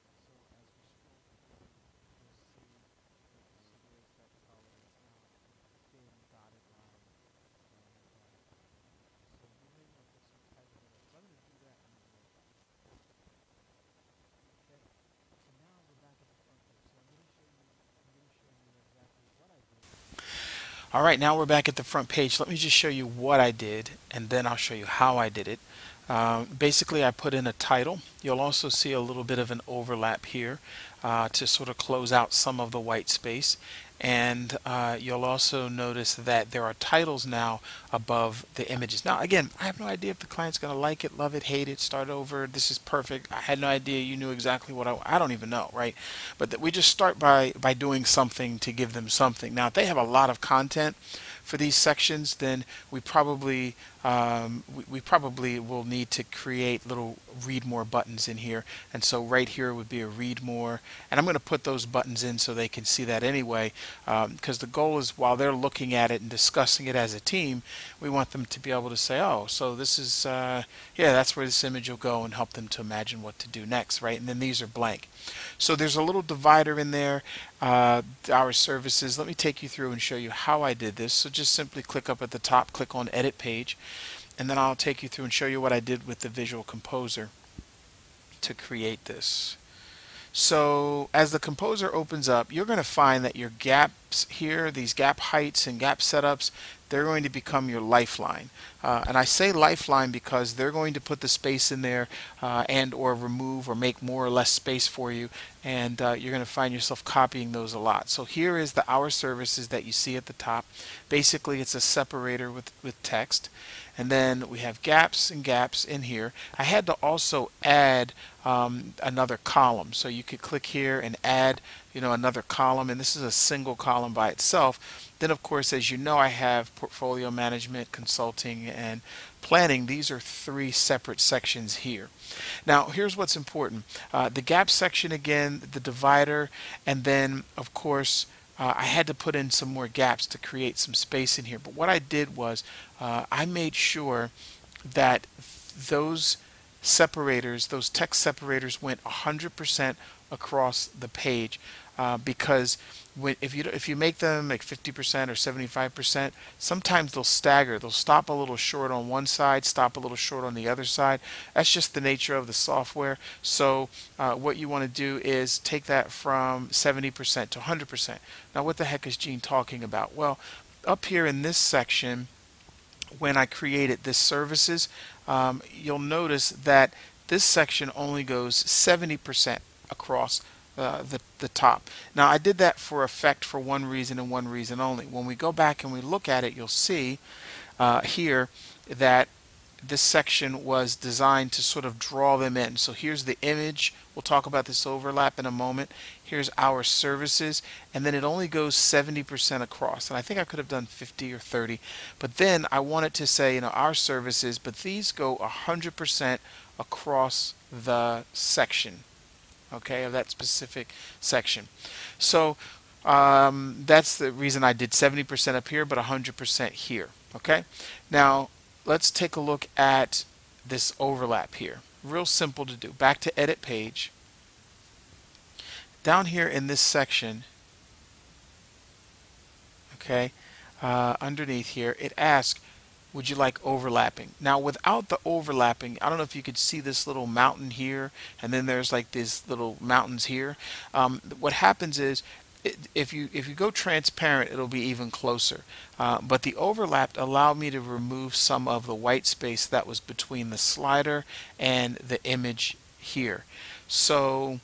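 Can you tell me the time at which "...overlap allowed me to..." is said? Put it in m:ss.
4:06.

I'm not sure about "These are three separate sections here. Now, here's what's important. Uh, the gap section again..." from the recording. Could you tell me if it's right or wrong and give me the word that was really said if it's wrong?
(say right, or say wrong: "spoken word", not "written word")
right.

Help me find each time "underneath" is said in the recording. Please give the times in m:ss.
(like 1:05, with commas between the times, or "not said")
3:51.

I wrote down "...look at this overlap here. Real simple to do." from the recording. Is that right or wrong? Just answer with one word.
right.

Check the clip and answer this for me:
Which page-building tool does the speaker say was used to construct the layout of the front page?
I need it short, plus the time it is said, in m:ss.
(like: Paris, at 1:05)
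Visual Composer, at 1:26.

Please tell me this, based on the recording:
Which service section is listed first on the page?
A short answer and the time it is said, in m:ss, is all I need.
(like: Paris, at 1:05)
portfolio management, at 2:06.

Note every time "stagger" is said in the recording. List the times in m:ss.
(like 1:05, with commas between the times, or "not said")
2:37.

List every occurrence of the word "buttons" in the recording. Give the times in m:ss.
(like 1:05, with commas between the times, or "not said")
0:57, 1:01.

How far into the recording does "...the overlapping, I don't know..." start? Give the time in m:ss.
3:55.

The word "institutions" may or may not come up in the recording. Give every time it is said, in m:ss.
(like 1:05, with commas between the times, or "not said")
not said.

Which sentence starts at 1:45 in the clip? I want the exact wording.
And uh, you're going to find yourself copying those a lot.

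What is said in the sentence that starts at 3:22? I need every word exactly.
But then I wanted to say, you know, our services, but these go 100% across the section okay, of that specific section.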